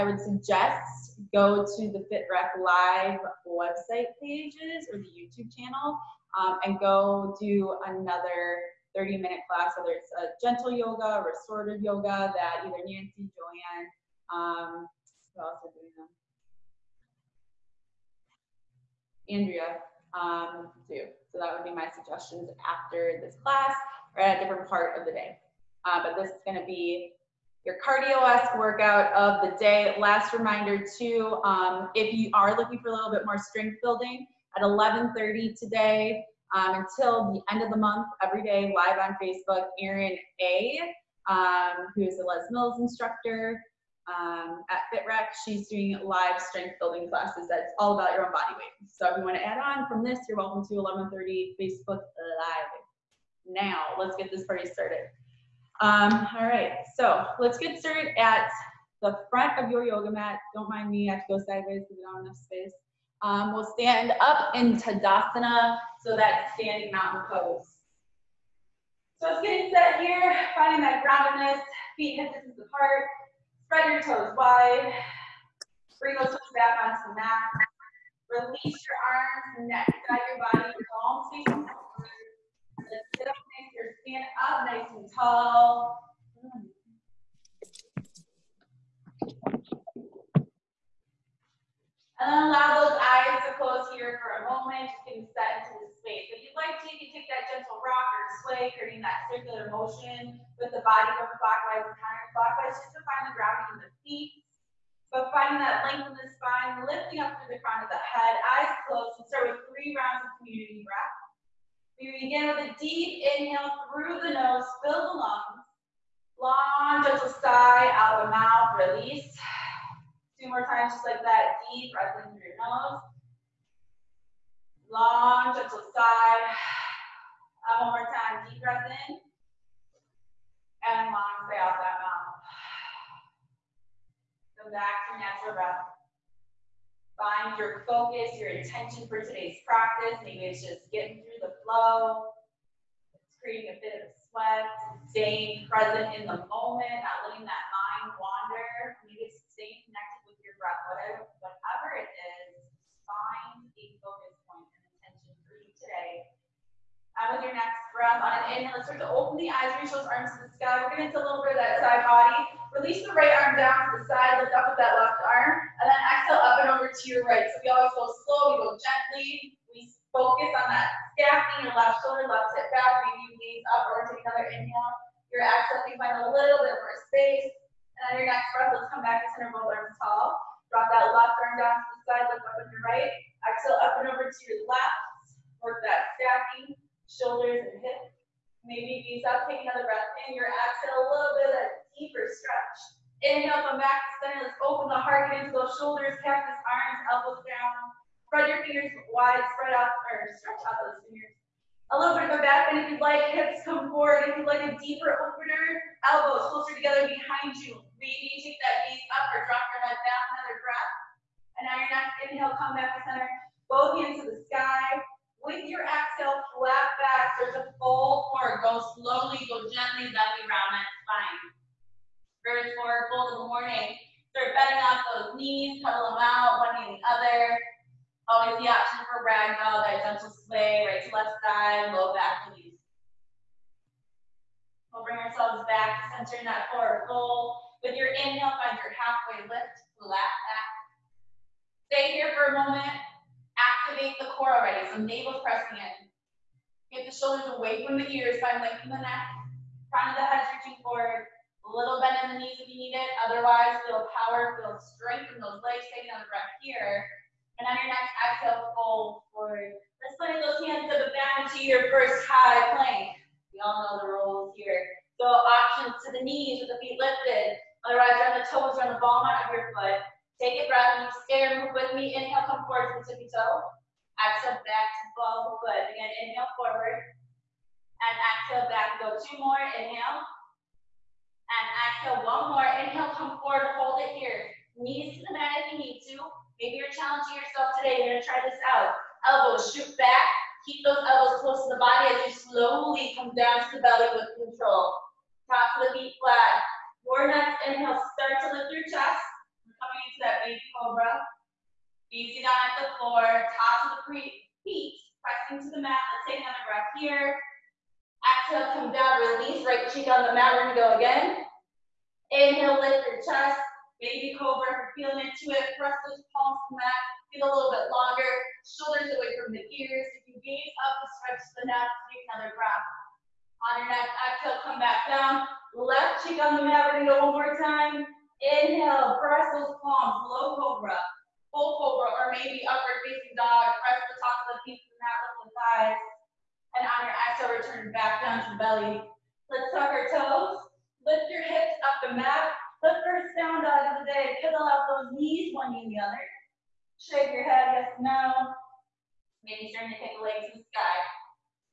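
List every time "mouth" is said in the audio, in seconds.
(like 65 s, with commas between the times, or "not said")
118 s, 132 s.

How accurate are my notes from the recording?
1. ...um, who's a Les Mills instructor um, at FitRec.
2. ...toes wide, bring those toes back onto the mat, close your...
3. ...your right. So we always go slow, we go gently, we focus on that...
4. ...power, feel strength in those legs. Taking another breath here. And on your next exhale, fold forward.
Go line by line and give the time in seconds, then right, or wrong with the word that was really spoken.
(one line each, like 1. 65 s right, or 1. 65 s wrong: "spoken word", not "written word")
1. 41 s right
2. 74 s wrong: "release", not "close"
3. 167 s right
4. 254 s right.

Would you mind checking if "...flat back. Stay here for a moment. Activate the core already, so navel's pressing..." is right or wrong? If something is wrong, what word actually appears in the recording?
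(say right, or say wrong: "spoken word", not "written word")
right.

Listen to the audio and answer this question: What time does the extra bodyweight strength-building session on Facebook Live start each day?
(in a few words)
11:30.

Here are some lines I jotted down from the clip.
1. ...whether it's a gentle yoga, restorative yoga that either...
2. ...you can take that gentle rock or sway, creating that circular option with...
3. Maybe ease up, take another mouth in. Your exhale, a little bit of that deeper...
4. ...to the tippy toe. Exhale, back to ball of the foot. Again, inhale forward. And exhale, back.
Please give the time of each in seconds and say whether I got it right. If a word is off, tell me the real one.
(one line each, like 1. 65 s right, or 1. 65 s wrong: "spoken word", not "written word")
1. 9 s right
2. 96 s wrong: "motion", not "option"
3. 188 s wrong: "breath", not "mouth"
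4. 272 s right.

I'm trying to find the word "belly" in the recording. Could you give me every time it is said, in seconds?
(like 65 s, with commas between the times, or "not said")
293 s, 338 s.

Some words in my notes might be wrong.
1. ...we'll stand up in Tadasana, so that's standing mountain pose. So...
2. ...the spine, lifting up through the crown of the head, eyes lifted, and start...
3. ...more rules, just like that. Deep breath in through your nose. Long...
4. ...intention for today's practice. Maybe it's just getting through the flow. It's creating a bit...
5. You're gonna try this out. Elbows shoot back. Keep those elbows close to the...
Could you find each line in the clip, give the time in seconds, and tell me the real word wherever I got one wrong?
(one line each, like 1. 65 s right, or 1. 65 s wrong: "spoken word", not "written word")
1. 63 s right
2. 106 s wrong: "closed", not "lifted"
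3. 120 s wrong: "times", not "rules"
4. 138 s right
5. 288 s right.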